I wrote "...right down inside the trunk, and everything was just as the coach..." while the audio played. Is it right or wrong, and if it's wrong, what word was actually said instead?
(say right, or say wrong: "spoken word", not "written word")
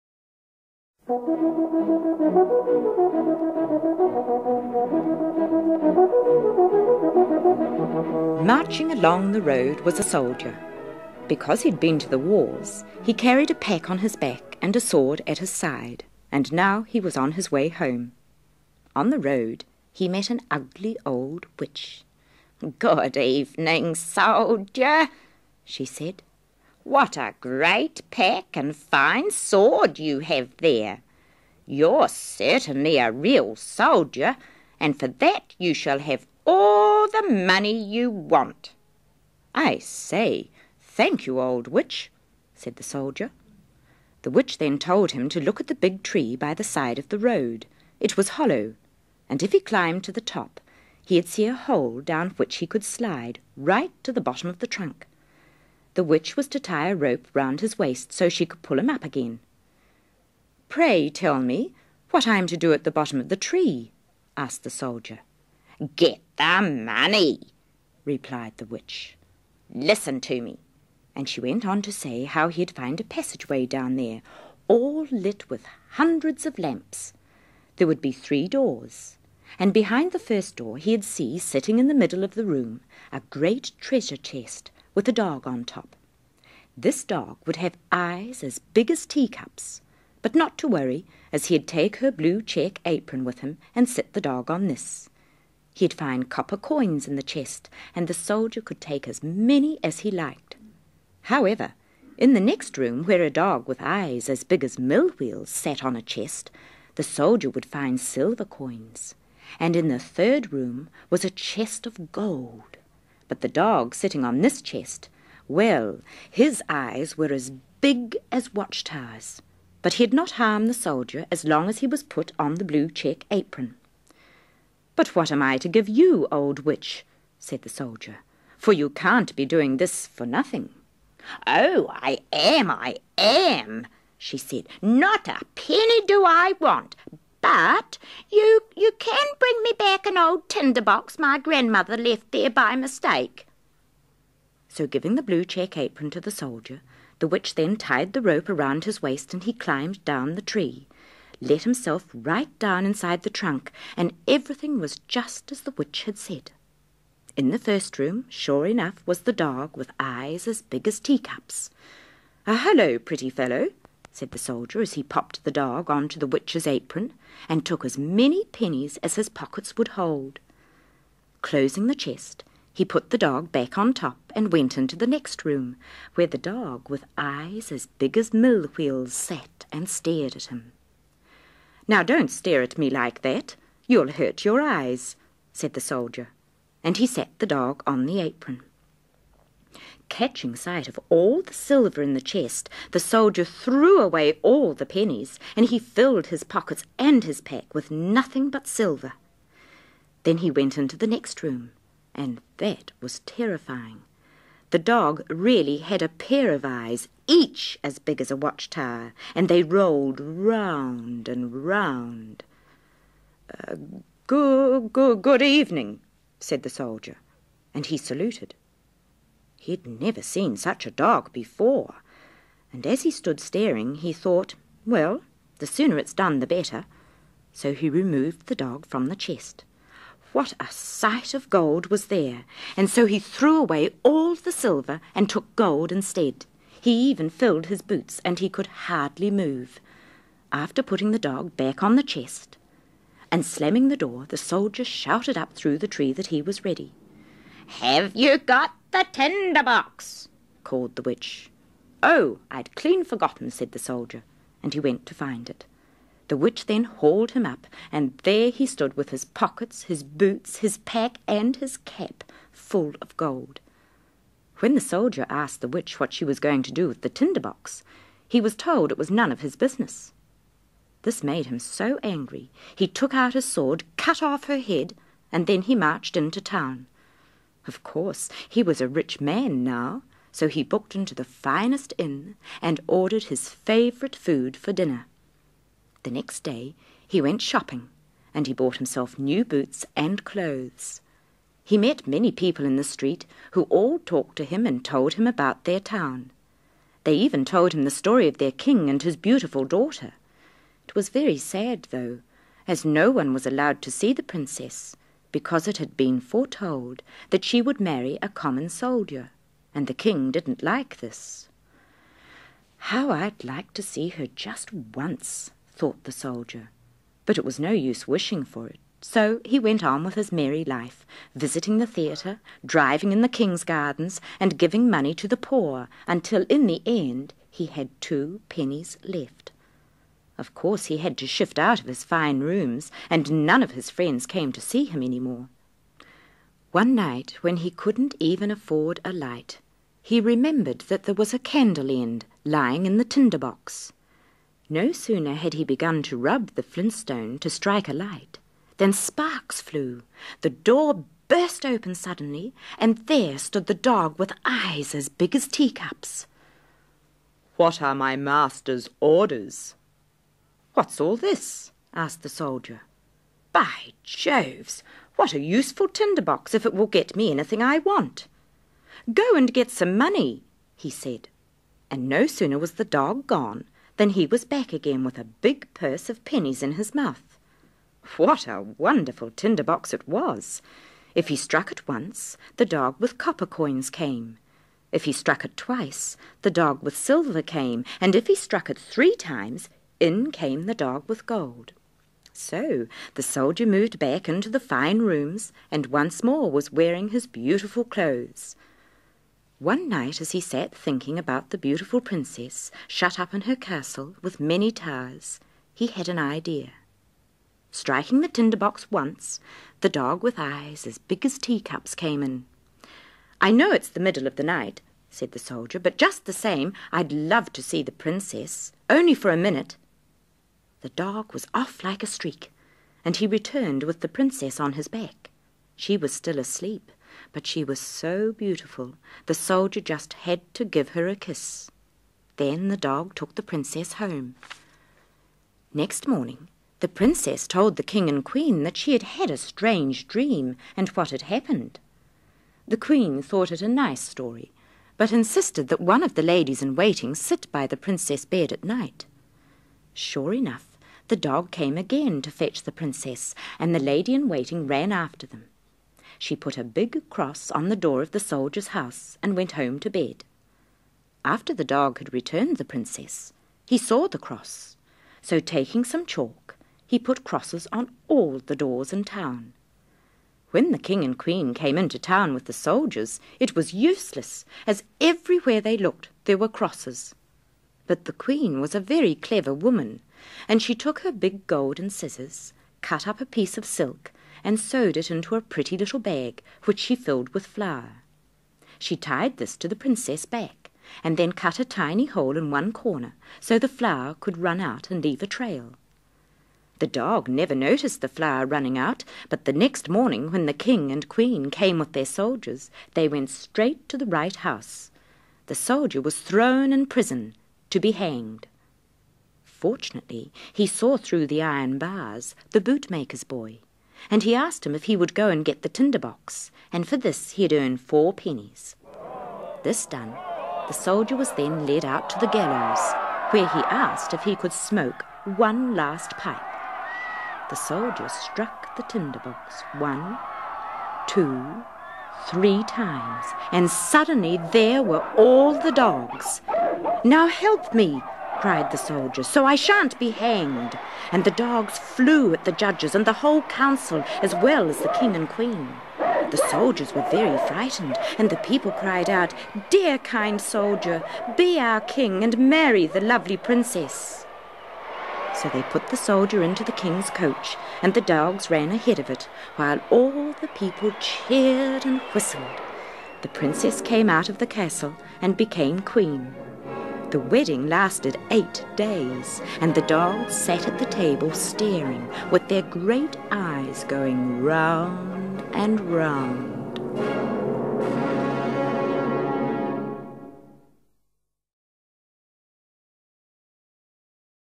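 wrong: "witch", not "coach".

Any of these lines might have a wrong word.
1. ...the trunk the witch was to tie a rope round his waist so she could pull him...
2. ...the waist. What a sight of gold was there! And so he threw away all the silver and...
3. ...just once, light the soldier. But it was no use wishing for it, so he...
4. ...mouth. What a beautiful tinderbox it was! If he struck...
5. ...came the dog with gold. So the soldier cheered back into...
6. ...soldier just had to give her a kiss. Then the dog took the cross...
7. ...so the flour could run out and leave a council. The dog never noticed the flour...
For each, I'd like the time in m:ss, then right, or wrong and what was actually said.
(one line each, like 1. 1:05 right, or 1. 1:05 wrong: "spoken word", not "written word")
1. 0:54 right
2. 3:49 wrong: "chest", not "waist"
3. 5:14 wrong: "thought", not "light"
4. 6:16 wrong: "wonderful", not "beautiful"
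5. 6:30 wrong: "moved", not "cheered"
6. 7:09 wrong: "princess", not "cross"
7. 8:13 wrong: "trail", not "council".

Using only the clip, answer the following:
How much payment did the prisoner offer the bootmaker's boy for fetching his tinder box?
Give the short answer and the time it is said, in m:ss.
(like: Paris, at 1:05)
4 pennies, at 8:37.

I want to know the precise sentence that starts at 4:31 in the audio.
This made him so angry, he took out his sword, cut off her head, and then he marched into town.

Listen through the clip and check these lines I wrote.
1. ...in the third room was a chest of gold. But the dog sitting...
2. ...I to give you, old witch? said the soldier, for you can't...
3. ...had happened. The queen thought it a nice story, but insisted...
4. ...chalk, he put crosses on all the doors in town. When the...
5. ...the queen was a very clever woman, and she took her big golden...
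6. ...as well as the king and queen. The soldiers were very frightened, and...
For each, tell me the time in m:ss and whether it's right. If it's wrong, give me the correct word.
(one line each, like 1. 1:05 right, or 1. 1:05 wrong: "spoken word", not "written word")
1. 1:49 right
2. 2:05 right
3. 7:21 right
4. 7:46 right
5. 7:58 right
6. 9:04 right.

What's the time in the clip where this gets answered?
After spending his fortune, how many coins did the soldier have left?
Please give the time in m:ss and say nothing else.
5:28.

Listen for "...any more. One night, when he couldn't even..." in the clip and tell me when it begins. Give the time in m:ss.
5:35.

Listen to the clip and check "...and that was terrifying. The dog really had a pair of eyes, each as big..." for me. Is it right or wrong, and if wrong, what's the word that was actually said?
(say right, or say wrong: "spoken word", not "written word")
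right.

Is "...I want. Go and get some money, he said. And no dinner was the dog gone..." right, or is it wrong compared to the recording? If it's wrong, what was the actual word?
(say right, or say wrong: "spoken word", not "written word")
wrong: "sooner", not "dinner".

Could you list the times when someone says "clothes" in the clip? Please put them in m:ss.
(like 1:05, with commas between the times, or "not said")
4:50, 6:37.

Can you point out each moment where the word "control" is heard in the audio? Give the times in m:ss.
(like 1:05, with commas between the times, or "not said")
not said.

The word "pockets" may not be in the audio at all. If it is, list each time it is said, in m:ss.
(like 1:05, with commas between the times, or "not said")
2:49, 3:16, 4:19.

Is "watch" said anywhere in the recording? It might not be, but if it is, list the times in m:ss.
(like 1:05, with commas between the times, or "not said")
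1:58, 3:28.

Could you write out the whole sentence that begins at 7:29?
Sure enough, the dog came again to fetch the princess, and the lady in waiting ran after them.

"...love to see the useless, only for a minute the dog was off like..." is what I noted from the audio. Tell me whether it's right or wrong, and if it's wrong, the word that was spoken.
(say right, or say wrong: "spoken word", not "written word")
wrong: "princess", not "useless".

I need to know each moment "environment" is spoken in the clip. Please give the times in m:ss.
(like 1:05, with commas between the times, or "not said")
not said.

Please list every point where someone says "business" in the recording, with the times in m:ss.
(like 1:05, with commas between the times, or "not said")
4:29.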